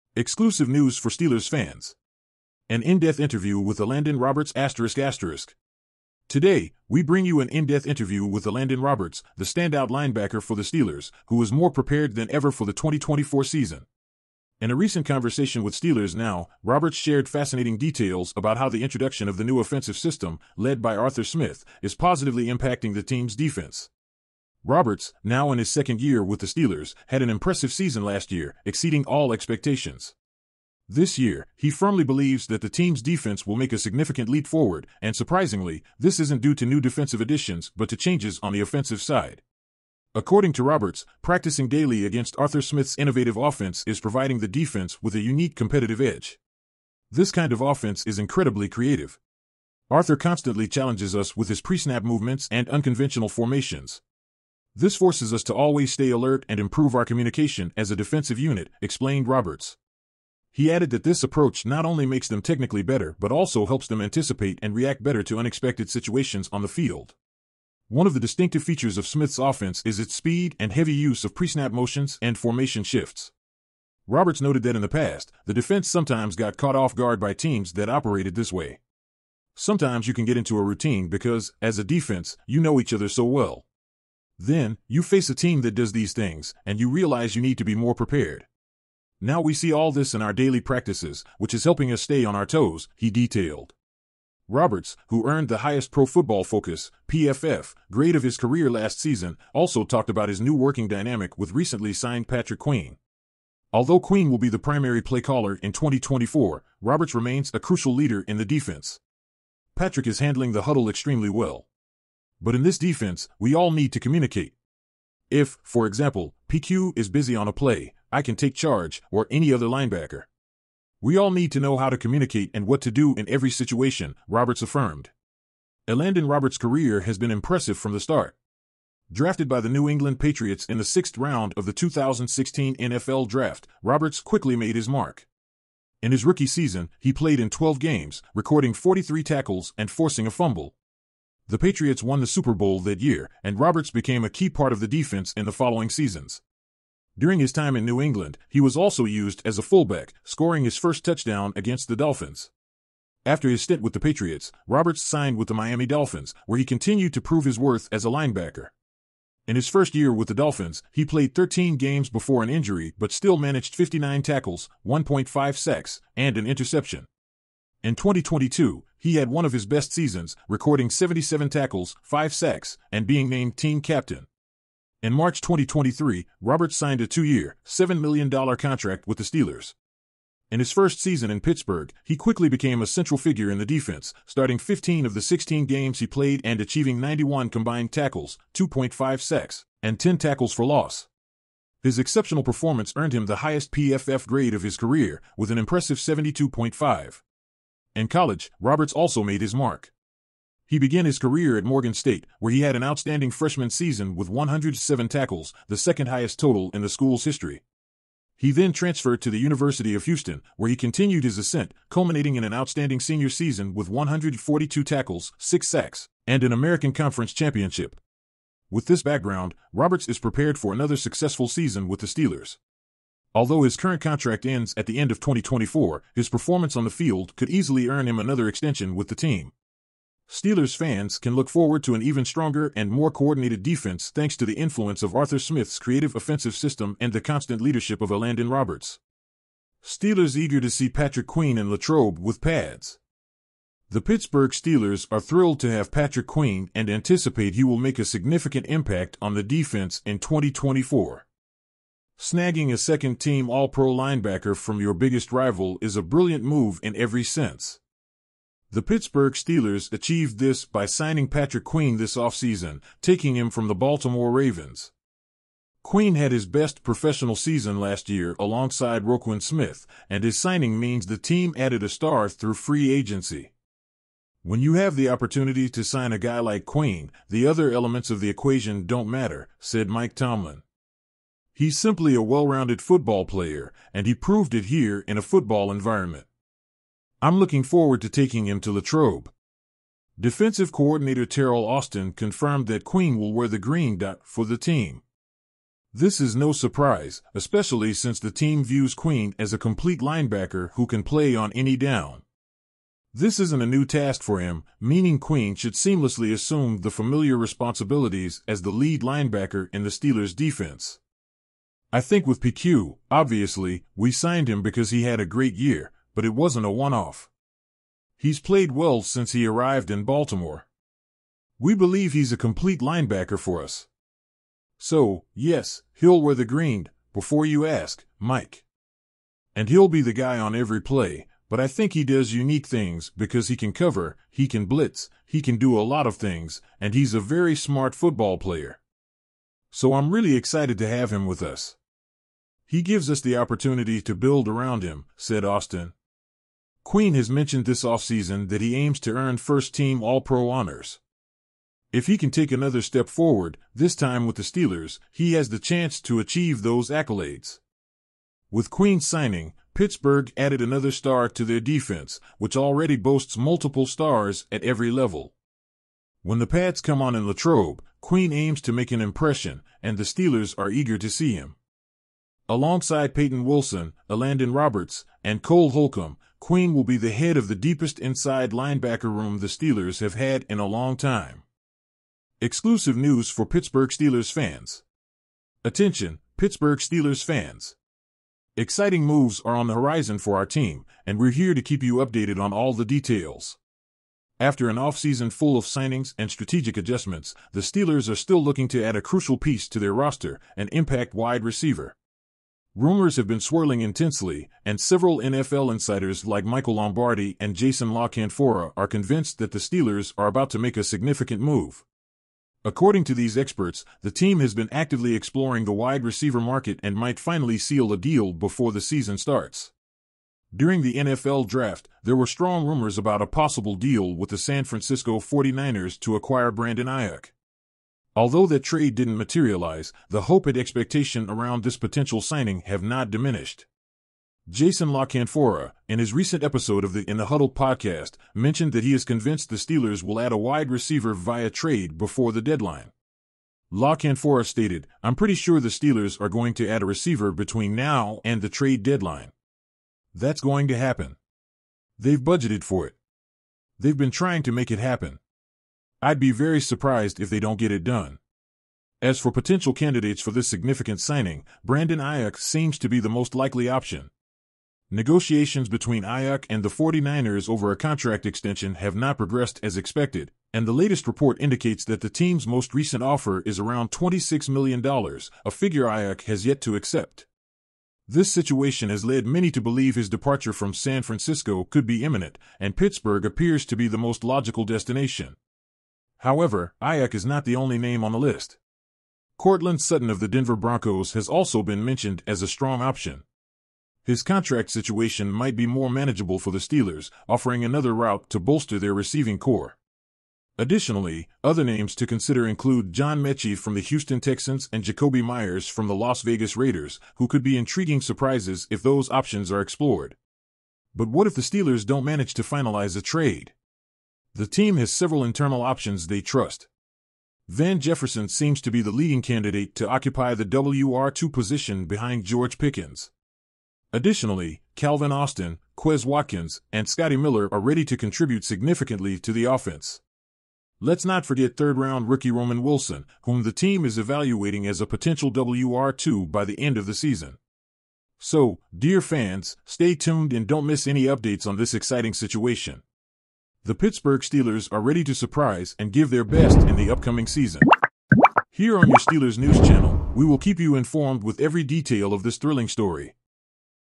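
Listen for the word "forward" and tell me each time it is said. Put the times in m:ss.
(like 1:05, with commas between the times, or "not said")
0:34, 3:51, 4:47, 5:53.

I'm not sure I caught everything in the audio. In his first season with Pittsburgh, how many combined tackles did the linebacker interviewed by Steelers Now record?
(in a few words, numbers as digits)
91.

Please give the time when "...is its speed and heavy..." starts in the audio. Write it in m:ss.
1:09.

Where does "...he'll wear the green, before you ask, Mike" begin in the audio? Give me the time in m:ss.
5:25.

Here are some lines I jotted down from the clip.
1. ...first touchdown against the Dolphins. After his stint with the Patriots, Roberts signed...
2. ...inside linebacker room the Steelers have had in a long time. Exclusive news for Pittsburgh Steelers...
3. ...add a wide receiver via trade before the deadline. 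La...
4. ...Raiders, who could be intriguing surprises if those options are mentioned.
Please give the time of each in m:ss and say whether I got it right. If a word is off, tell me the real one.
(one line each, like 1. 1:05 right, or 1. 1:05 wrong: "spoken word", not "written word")
1. 2:30 right
2. 6:17 right
3. 7:20 right
4. 8:26 wrong: "explored", not "mentioned".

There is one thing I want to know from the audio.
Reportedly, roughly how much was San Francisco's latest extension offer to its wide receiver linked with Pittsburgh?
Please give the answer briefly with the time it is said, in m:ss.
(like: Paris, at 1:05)
$26 million, at 7:53.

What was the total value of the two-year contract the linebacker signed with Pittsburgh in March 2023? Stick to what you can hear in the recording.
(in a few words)
$7 million.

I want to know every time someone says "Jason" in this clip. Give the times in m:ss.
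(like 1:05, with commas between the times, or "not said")
6:47, 7:14.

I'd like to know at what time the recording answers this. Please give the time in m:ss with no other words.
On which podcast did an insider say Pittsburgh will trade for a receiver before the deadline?
7:17.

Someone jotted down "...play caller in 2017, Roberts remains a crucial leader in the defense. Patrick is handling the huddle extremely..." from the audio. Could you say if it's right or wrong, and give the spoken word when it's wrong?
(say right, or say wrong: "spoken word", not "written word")
wrong: "2024", not "2017".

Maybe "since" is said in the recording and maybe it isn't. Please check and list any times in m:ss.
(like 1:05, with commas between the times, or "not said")
4:57, 5:19.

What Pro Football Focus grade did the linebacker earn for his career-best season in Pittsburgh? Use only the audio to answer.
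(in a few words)
72.5.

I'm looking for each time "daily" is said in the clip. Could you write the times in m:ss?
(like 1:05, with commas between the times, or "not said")
0:41, 1:30.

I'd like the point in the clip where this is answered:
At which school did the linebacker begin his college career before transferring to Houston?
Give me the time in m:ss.
3:21.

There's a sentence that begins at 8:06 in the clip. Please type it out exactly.
However, Aiyuk is not the only name on the list.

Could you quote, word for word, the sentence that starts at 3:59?
Steelers eager to see Patrick Queen and Latrobe with pads.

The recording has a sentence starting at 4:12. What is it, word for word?
Snagging a second team All Pro linebacker from your biggest rival is a brilliant move in every sense.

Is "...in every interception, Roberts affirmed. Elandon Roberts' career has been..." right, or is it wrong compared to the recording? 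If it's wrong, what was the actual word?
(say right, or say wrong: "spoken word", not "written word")
wrong: "situation", not "interception".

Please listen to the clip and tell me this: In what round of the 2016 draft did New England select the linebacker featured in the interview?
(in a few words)
sixth.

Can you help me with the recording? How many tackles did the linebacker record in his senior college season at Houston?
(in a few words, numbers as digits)
142.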